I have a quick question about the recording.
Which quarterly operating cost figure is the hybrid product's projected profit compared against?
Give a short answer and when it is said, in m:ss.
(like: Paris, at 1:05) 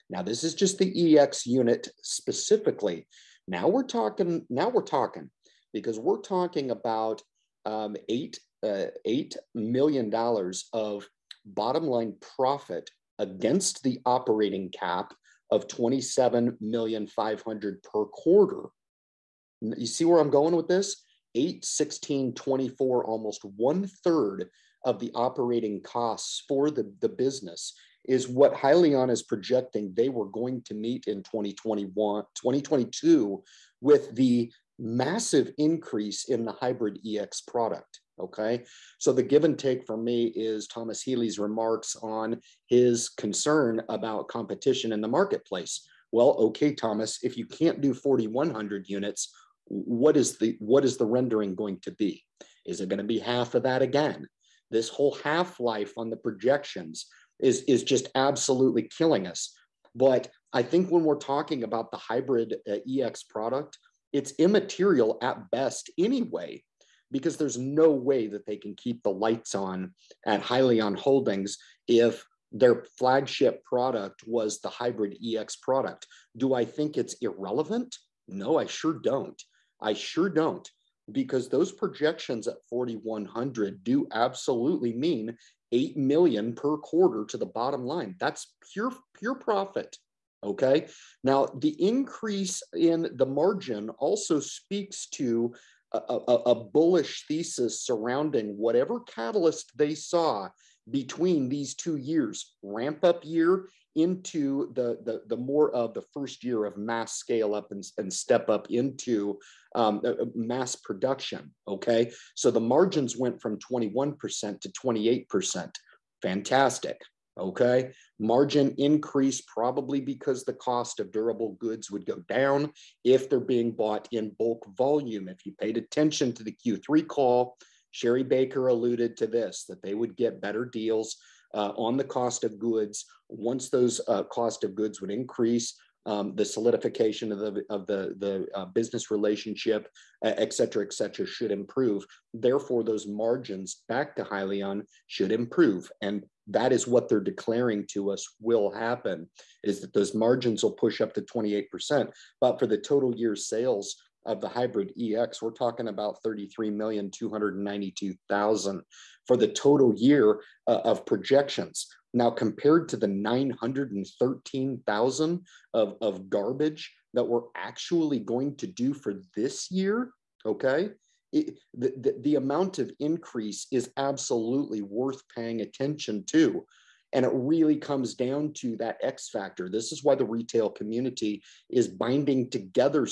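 27 million 500, at 0:15.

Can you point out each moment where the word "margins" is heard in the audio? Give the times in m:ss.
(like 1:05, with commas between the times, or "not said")
1:33, 1:52, 1:58, 2:23, 2:30.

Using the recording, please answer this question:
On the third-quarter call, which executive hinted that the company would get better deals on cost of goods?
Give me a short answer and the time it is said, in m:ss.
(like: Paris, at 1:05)
Sherry Baker, at 2:07.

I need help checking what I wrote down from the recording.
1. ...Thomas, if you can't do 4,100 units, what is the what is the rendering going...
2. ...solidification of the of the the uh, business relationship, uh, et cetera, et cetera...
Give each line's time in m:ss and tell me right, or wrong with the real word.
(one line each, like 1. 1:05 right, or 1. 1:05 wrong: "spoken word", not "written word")
1. 0:46 right
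2. 2:16 right.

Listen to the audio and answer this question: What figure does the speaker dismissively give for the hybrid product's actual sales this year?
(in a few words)
913,000.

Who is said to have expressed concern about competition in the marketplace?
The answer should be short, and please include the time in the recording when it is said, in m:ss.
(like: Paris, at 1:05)
Thomas Healy, at 0:40.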